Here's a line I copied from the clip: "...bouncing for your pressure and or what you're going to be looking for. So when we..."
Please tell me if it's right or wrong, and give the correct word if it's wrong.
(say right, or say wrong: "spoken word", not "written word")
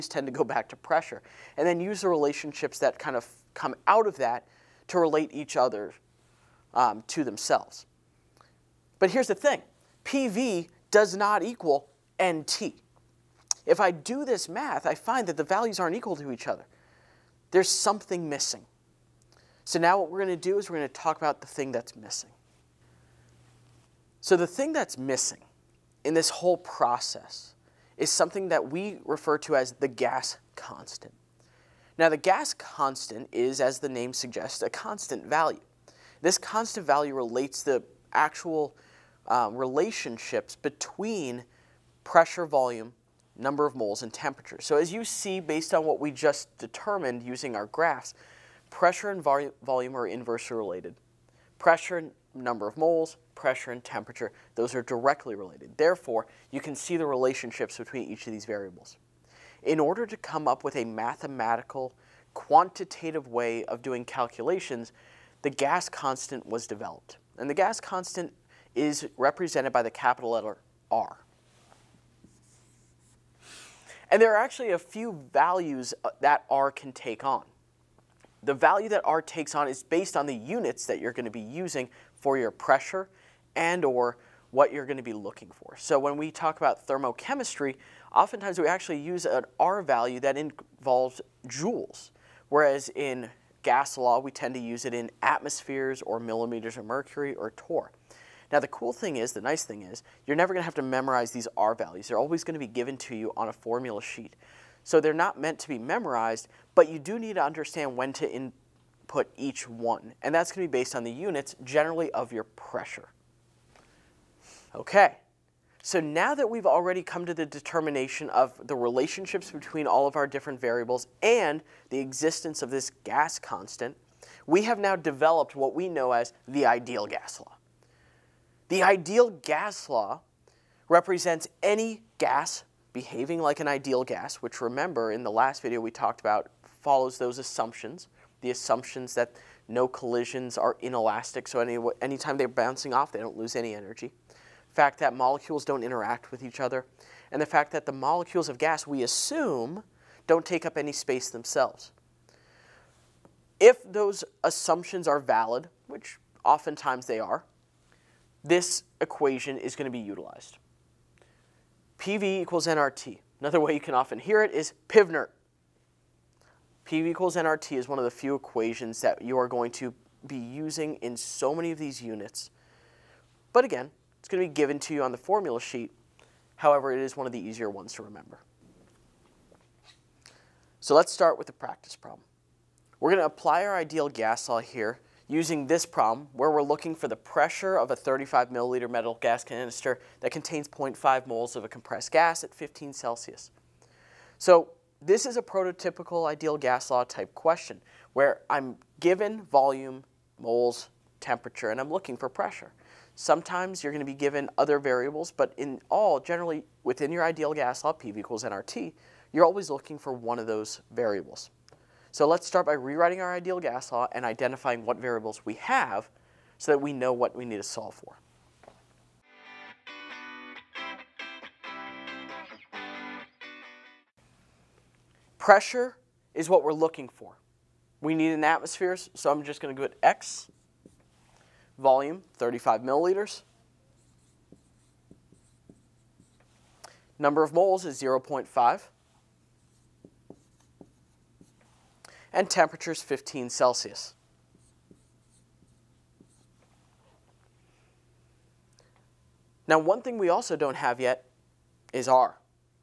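wrong: "using", not "bouncing".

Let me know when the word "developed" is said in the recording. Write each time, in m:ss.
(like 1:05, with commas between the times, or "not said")
1:06, 2:04.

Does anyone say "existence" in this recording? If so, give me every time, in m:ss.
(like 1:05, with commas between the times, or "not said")
2:01.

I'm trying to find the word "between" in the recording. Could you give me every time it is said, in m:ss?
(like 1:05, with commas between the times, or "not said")
0:40, 0:57, 1:59.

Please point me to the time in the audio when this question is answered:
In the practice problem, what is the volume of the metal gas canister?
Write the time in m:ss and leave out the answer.
3:07.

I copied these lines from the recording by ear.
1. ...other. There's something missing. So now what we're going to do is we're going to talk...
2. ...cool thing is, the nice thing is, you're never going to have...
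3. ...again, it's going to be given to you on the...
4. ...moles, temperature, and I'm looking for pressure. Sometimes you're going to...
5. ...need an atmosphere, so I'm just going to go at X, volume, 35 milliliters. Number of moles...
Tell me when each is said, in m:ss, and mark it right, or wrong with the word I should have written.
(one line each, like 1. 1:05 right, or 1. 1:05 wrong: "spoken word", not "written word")
1. 0:16 right
2. 1:38 right
3. 2:53 right
4. 3:20 right
5. 3:48 right.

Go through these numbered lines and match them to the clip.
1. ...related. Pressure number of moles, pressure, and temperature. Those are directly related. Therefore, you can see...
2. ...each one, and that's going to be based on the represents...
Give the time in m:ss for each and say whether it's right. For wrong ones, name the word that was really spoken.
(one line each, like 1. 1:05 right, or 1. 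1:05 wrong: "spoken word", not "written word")
1. 0:50 right
2. 1:49 wrong: "units", not "represents".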